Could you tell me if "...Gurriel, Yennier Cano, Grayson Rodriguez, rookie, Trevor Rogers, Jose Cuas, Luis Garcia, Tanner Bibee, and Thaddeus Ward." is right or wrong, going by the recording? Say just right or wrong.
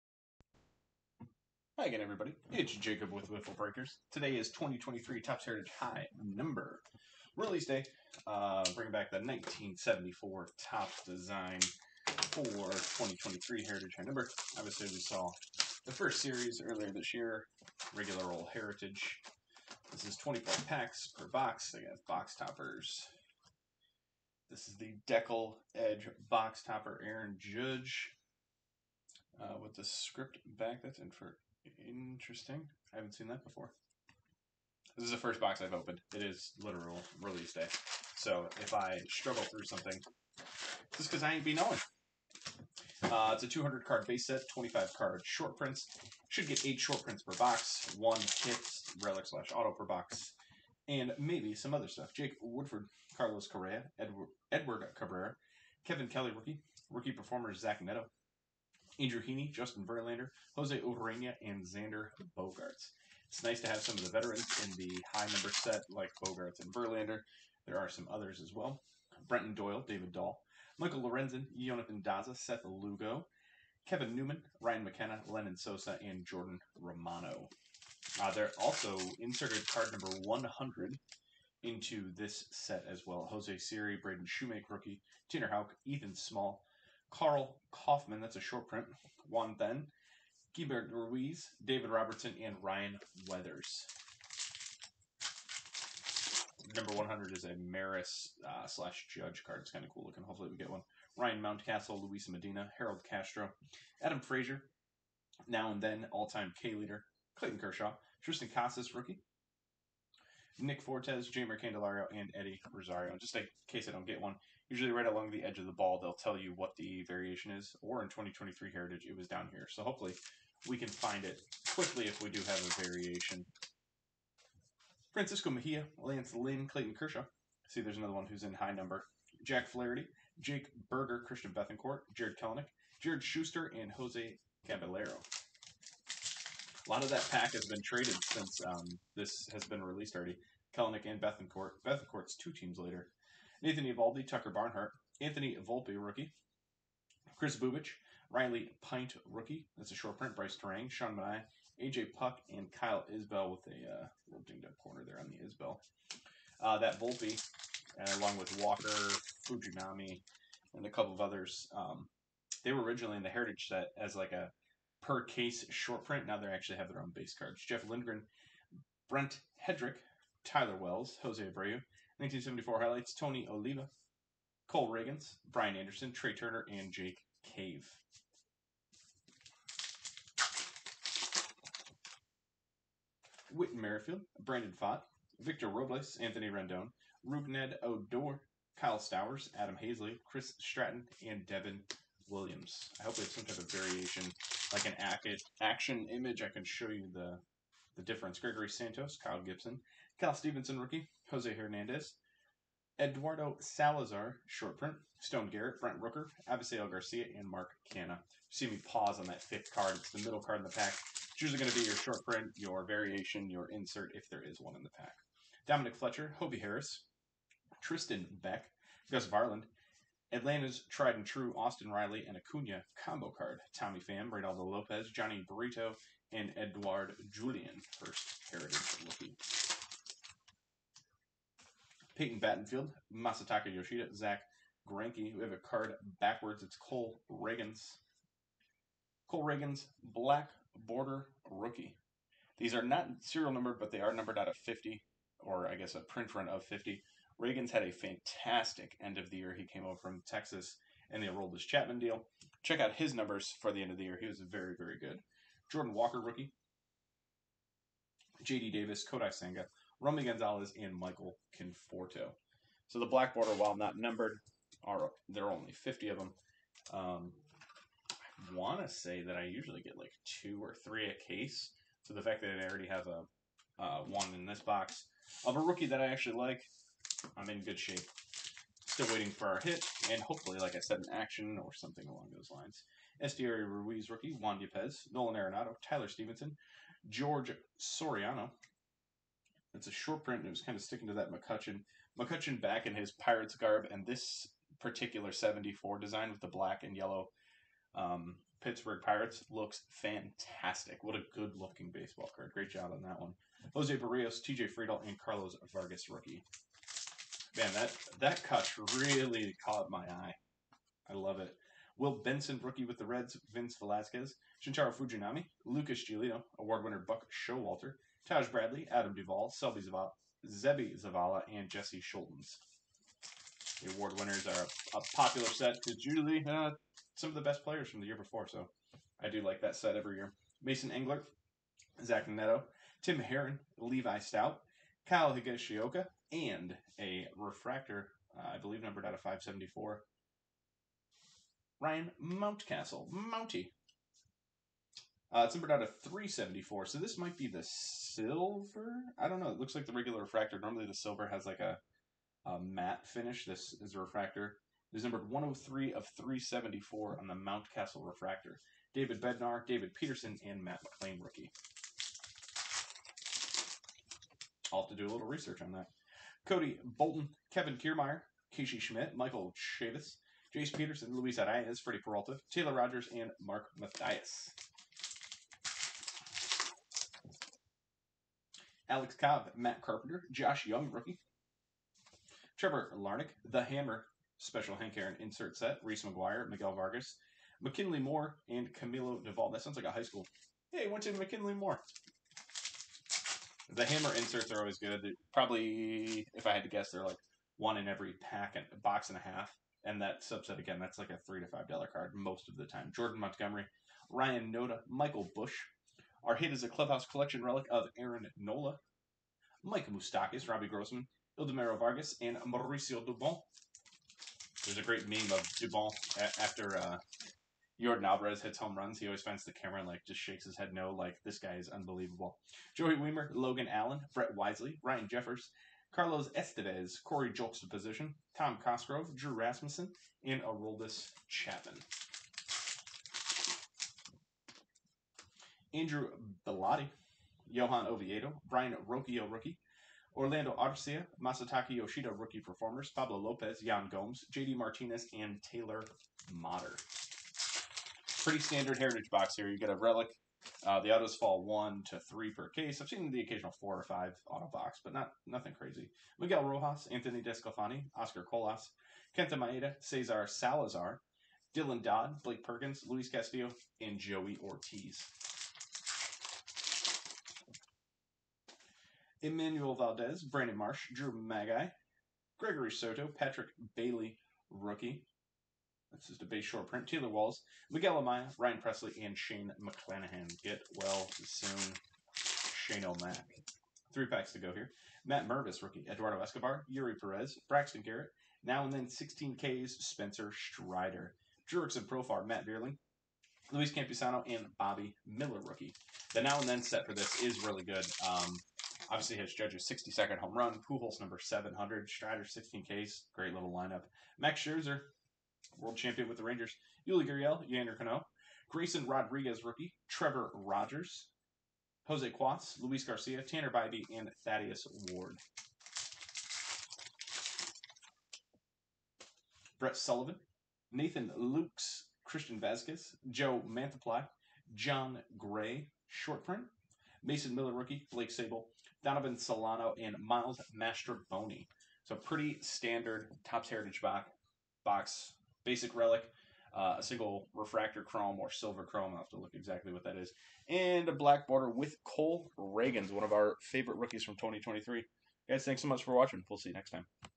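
right.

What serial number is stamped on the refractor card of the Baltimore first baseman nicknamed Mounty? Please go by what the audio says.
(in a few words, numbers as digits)
103 of 374.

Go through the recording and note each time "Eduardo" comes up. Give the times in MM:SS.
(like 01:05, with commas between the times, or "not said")
03:23, 08:05.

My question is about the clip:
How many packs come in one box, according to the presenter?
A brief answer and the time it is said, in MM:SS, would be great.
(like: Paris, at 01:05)
24, at 00:20.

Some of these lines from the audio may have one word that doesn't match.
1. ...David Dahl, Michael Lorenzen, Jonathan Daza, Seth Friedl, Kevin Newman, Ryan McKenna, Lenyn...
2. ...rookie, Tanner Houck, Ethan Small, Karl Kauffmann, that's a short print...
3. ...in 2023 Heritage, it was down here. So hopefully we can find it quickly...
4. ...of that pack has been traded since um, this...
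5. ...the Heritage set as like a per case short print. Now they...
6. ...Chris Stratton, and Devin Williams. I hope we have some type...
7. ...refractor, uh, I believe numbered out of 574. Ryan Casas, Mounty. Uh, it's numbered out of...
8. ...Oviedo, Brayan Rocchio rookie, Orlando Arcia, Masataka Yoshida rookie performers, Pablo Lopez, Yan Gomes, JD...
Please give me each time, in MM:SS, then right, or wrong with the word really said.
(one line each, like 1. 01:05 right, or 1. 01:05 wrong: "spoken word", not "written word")
1. 01:09 wrong: "Lugo", not "Friedl"
2. 01:24 right
3. 01:58 right
4. 02:17 right
5. 02:43 right
6. 03:10 right
7. 05:37 wrong: "Mountcastle", not "Casas"
8. 07:17 right.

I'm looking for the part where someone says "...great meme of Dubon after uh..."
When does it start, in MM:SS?
06:54.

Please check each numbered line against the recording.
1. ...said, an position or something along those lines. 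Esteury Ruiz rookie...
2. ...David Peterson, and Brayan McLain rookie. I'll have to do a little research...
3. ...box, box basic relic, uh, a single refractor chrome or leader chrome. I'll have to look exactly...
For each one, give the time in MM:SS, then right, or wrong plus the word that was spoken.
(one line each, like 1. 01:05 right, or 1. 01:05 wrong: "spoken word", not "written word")
1. 04:40 wrong: "action", not "position"
2. 05:59 wrong: "Matt", not "Brayan"
3. 08:53 wrong: "silver", not "leader".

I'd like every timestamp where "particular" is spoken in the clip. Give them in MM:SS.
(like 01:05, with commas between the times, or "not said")
04:54.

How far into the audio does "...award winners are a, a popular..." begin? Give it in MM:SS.
05:23.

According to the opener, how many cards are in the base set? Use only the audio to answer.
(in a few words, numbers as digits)
200.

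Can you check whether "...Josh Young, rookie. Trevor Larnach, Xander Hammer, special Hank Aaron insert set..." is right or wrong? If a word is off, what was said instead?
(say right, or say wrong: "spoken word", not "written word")
wrong: "The", not "Xander".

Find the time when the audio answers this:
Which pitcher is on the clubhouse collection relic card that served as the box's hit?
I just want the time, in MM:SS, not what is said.
06:47.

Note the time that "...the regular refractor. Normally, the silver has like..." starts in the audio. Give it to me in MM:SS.
05:49.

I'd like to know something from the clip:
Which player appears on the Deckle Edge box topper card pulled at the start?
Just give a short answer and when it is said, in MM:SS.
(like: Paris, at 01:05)
Aaron Judge, at 00:27.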